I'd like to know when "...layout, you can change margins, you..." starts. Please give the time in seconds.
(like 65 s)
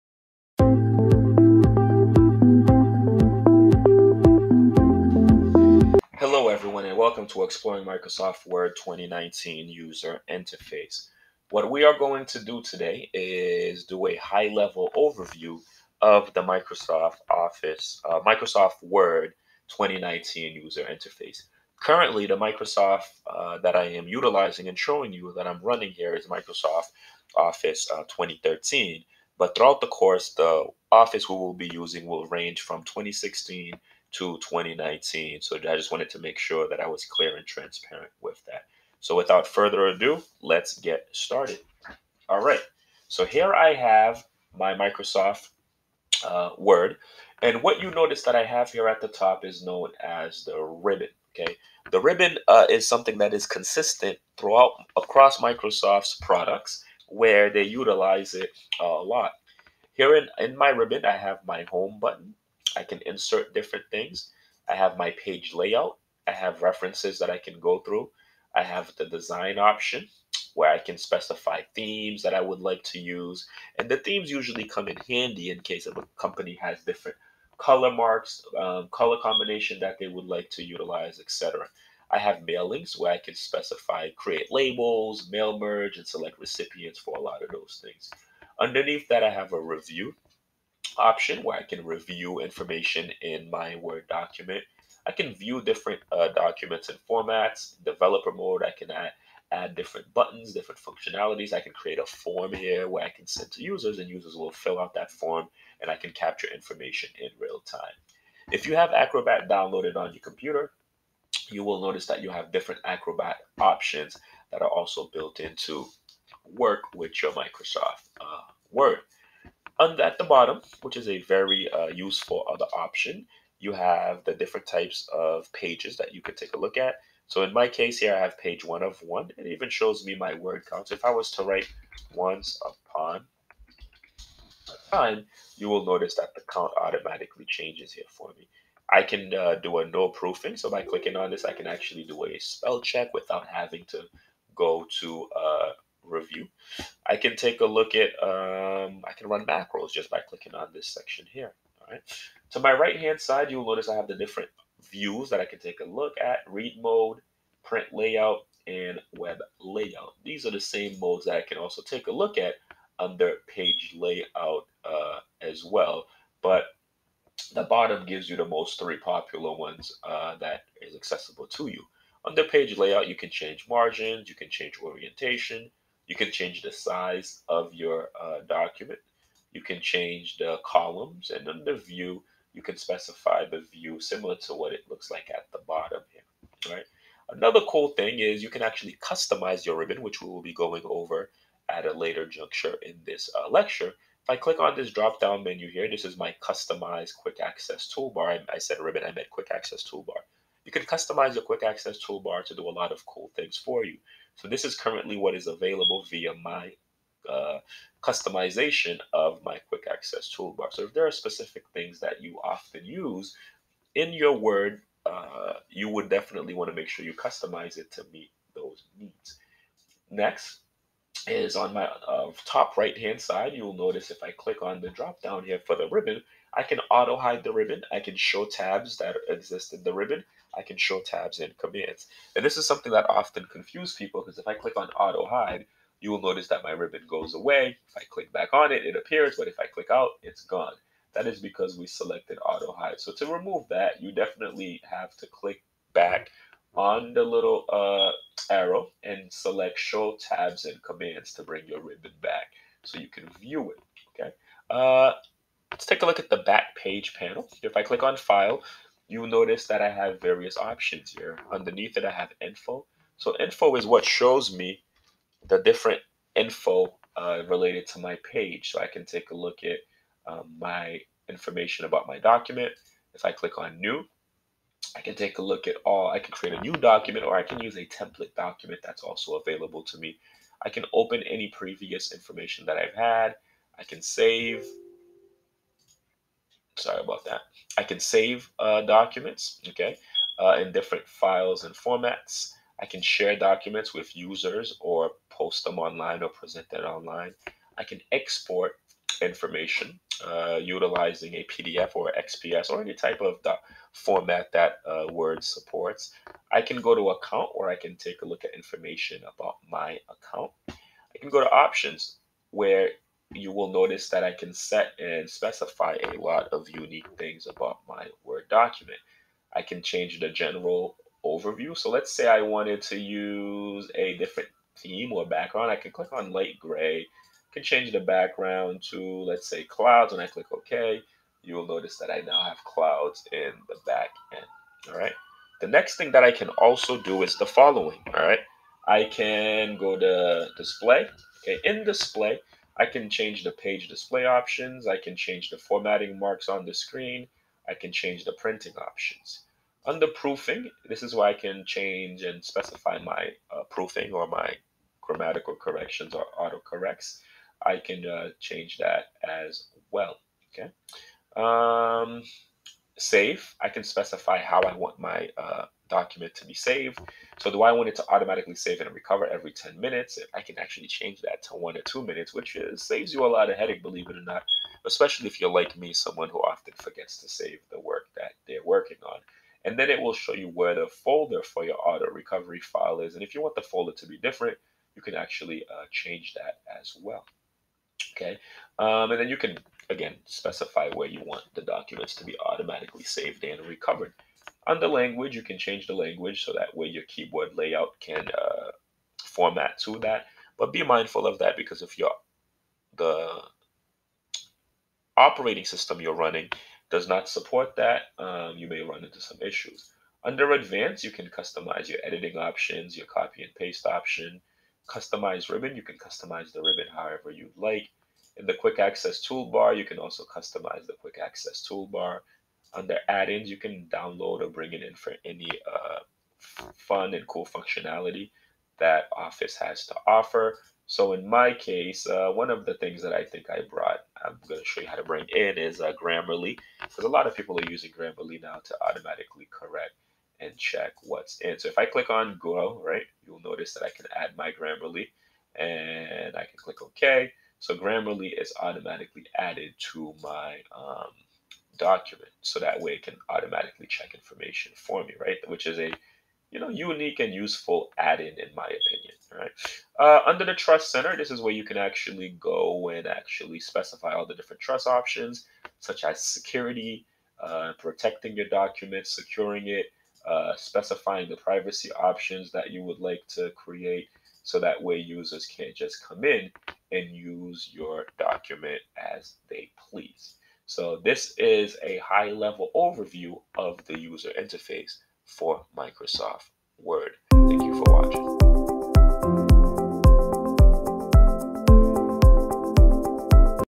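172 s.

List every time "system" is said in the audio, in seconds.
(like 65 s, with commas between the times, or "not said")
405 s.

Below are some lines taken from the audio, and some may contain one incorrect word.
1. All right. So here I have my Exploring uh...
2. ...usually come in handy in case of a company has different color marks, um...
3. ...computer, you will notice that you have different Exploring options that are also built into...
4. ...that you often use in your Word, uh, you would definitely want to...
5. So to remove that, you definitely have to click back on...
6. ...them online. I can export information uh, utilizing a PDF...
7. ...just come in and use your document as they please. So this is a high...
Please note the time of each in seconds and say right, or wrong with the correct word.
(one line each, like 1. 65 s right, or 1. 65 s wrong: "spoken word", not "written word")
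1. 42 s wrong: "Microsoft", not "Exploring"
2. 74 s right
3. 110 s wrong: "Acrobat", not "Exploring"
4. 211 s right
5. 242 s right
6. 296 s right
7. 475 s right.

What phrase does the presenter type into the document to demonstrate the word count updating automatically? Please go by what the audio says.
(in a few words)
Once upon a time.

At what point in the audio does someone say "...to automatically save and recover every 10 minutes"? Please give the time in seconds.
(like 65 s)
367 s.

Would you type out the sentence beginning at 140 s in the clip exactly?
So by clicking on this, I can actually do a spell check without having to go to uh, review.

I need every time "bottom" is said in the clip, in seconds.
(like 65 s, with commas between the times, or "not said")
120 s, 167 s, 185 s.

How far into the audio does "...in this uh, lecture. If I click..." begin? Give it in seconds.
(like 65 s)
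192 s.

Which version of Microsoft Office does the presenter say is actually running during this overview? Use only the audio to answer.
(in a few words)
Office 2013.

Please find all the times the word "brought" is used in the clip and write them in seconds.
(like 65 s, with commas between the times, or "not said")
433 s.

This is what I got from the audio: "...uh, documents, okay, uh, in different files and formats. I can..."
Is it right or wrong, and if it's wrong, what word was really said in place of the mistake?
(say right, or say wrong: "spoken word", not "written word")
right.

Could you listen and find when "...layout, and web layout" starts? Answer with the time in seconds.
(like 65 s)
157 s.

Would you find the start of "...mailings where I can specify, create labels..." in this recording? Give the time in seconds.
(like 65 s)
82 s.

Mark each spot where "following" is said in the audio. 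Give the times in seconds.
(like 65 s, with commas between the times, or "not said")
337 s.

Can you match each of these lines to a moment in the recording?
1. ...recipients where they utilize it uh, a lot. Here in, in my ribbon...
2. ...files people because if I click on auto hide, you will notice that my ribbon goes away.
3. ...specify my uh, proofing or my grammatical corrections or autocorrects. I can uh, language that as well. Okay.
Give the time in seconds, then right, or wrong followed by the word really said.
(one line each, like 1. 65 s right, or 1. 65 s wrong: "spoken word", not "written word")
1. 56 s wrong: "products", not "recipients"
2. 233 s wrong: "confuses", not "files"
3. 352 s wrong: "change", not "language".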